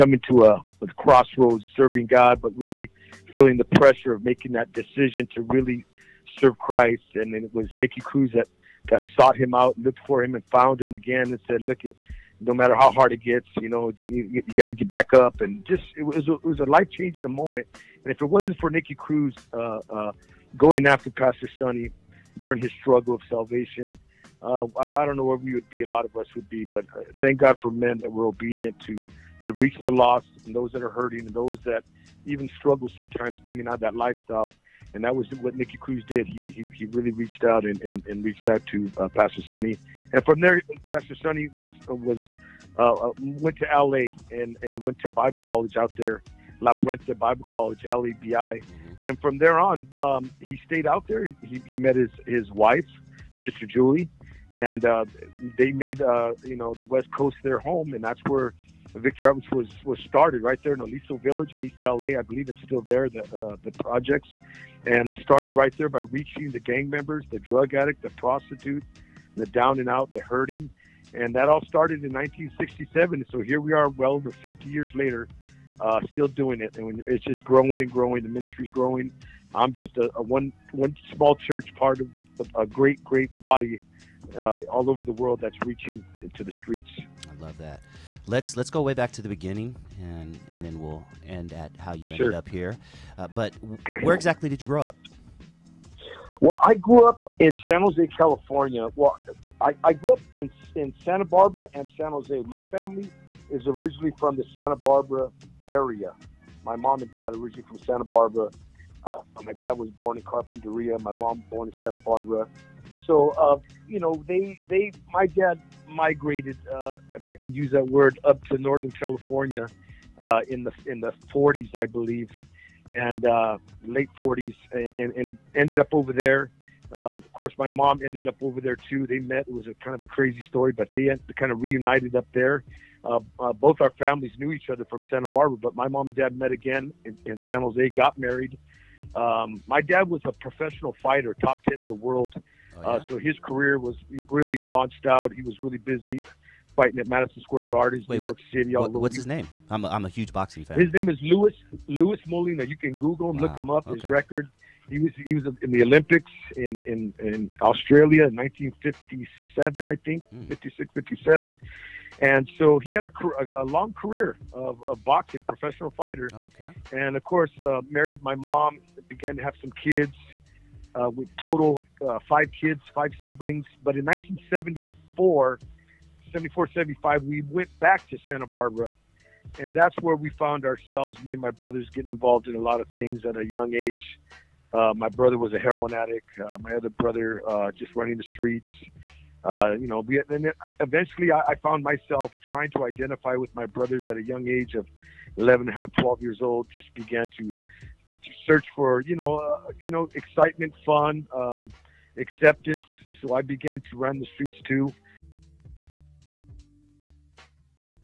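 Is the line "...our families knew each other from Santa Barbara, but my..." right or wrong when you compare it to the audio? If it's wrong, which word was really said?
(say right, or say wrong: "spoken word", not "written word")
right.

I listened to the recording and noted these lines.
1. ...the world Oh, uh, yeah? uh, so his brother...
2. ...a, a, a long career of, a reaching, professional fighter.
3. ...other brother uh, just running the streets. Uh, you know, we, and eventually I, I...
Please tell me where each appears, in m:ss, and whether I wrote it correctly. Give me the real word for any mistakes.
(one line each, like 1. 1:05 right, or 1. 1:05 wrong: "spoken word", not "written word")
1. 2:21 wrong: "career", not "brother"
2. 2:43 wrong: "boxing", not "reaching"
3. 3:06 right.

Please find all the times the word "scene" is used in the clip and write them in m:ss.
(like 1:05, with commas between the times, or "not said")
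not said.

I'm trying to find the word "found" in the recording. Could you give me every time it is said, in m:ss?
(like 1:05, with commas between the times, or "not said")
0:10, 3:00, 3:11.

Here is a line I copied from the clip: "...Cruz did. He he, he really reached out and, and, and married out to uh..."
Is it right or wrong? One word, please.
wrong.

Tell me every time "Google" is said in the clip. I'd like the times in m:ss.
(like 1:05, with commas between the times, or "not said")
2:32.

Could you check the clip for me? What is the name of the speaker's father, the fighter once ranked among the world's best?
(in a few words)
Louis Molina.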